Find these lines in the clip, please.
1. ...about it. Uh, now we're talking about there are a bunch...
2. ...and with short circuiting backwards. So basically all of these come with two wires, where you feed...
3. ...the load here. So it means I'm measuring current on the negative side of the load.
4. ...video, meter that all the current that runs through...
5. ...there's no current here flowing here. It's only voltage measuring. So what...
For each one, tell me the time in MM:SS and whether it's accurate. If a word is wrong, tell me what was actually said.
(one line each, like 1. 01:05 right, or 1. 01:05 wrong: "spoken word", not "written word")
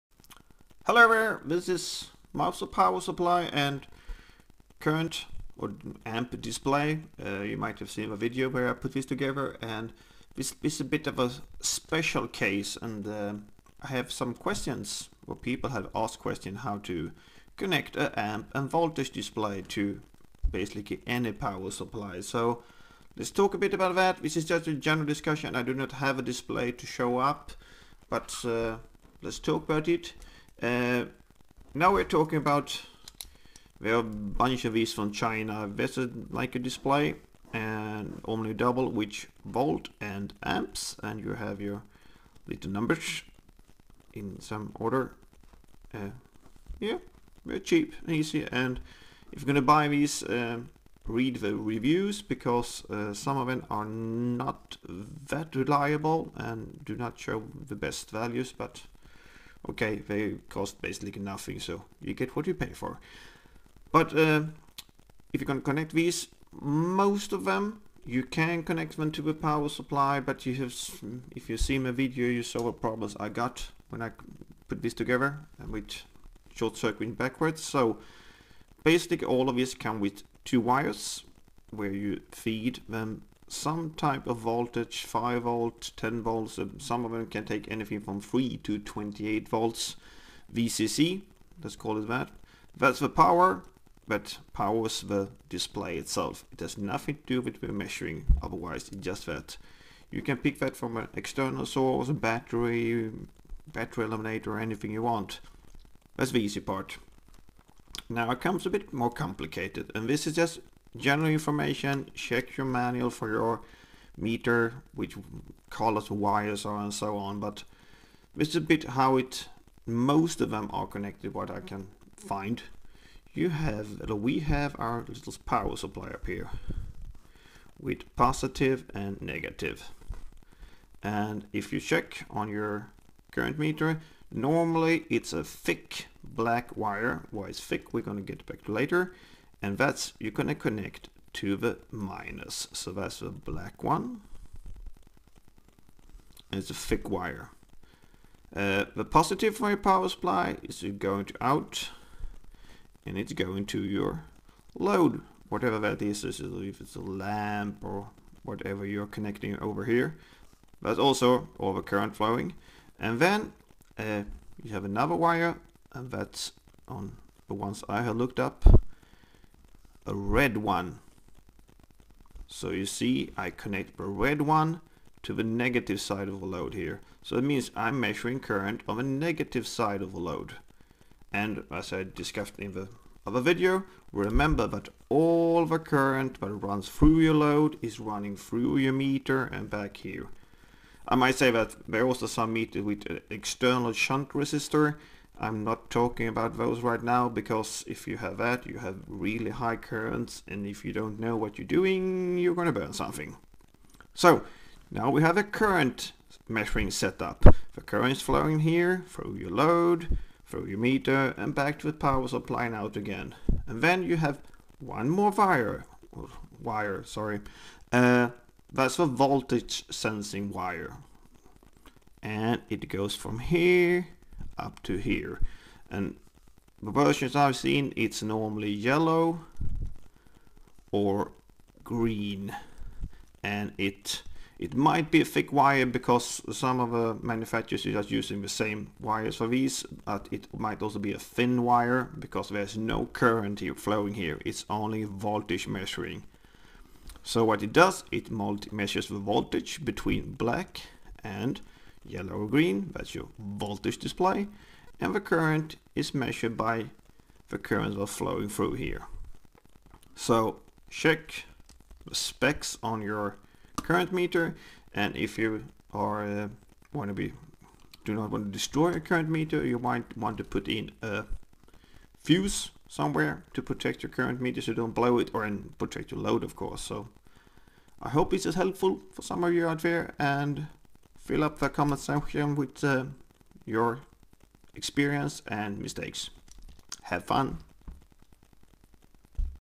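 1. 00:29 right
2. 01:15 right
3. 02:56 right
4. 03:03 wrong: "remember", not "meter"
5. 04:02 right.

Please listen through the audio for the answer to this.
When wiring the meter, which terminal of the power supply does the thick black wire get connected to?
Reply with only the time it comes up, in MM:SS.
02:21.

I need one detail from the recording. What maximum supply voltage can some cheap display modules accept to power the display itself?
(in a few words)
28 volts.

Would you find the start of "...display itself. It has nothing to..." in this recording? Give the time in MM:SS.
01:35.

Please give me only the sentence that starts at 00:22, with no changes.
So let's talk a bit about that.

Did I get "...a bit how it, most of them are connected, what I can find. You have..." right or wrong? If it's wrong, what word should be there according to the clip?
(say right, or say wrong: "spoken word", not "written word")
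right.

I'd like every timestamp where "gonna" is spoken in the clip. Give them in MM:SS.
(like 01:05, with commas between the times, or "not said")
00:49, 02:18.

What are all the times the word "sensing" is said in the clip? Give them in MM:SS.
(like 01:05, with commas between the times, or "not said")
03:39.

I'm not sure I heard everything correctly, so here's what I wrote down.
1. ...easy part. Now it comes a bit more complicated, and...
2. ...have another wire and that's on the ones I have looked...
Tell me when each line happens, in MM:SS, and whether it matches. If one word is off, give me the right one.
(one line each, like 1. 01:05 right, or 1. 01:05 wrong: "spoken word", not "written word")
1. 01:46 right
2. 02:44 right.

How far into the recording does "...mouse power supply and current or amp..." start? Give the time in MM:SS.
00:02.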